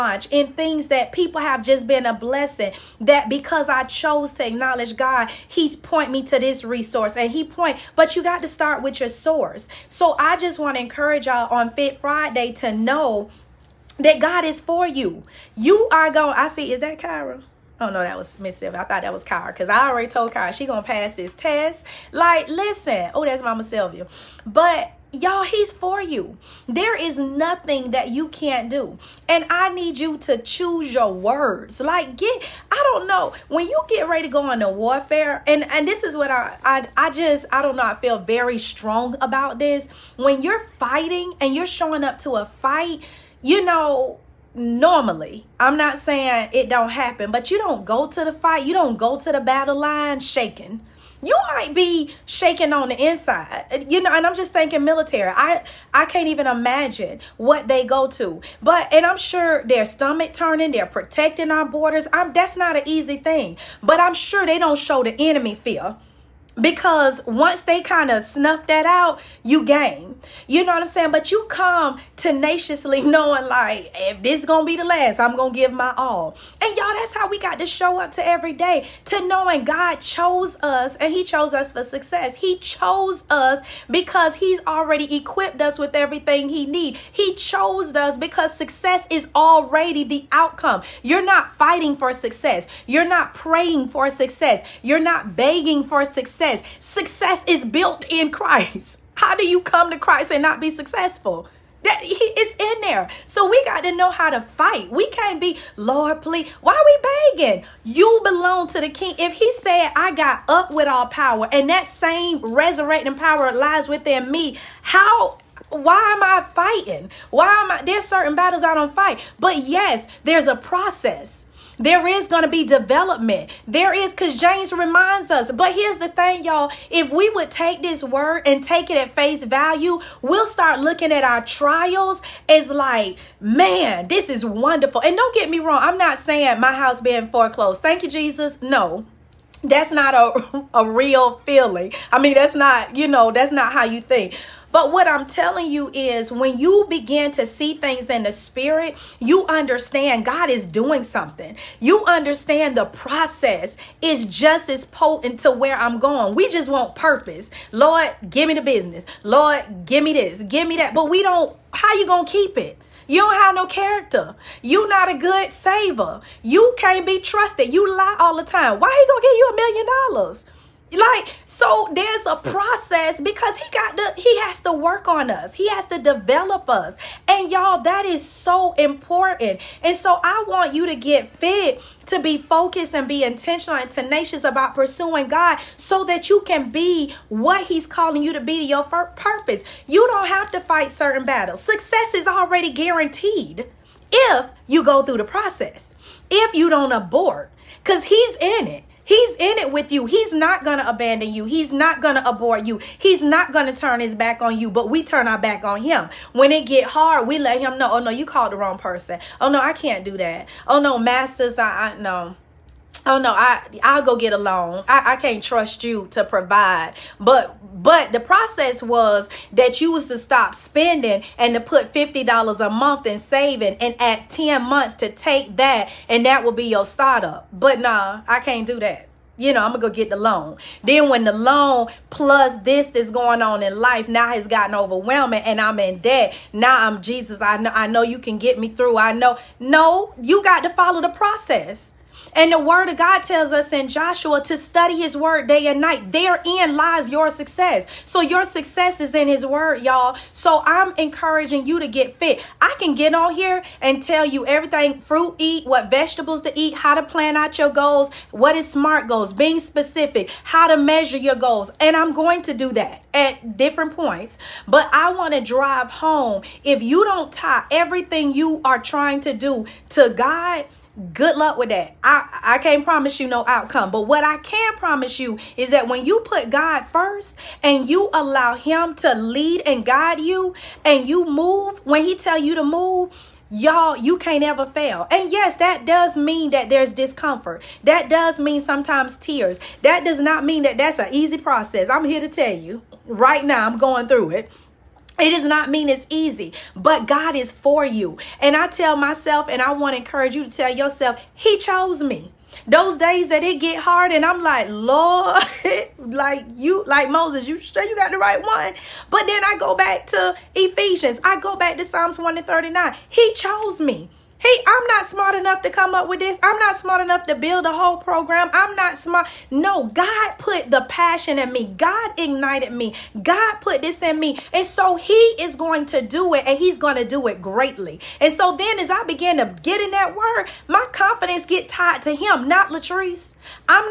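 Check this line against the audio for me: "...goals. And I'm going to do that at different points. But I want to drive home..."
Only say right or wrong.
right.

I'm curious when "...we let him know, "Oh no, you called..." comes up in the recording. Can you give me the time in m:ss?
3:27.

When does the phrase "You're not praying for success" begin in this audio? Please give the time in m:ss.
1:32.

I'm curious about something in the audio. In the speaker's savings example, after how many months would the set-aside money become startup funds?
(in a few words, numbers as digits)
10.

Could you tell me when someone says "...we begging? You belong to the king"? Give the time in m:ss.
1:46.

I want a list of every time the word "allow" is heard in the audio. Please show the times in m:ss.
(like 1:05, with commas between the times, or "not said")
4:38.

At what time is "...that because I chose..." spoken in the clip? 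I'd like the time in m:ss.
0:02.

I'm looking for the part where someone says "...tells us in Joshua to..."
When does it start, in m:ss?
4:03.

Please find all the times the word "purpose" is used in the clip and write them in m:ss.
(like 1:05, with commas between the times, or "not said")
2:36, 3:08.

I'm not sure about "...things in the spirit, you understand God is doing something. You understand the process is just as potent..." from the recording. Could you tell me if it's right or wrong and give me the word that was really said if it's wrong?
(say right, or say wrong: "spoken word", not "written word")
right.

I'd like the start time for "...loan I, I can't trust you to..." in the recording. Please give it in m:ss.
3:34.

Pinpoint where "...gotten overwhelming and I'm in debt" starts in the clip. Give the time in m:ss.
3:54.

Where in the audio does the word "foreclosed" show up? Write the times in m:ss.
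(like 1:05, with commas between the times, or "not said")
2:17.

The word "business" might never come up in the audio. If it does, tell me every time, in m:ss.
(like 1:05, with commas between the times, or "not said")
2:38.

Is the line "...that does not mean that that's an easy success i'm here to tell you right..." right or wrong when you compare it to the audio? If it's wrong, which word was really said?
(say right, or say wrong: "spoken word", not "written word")
wrong: "process", not "success".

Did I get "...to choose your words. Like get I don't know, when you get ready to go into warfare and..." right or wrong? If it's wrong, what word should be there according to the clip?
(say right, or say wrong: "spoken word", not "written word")
right.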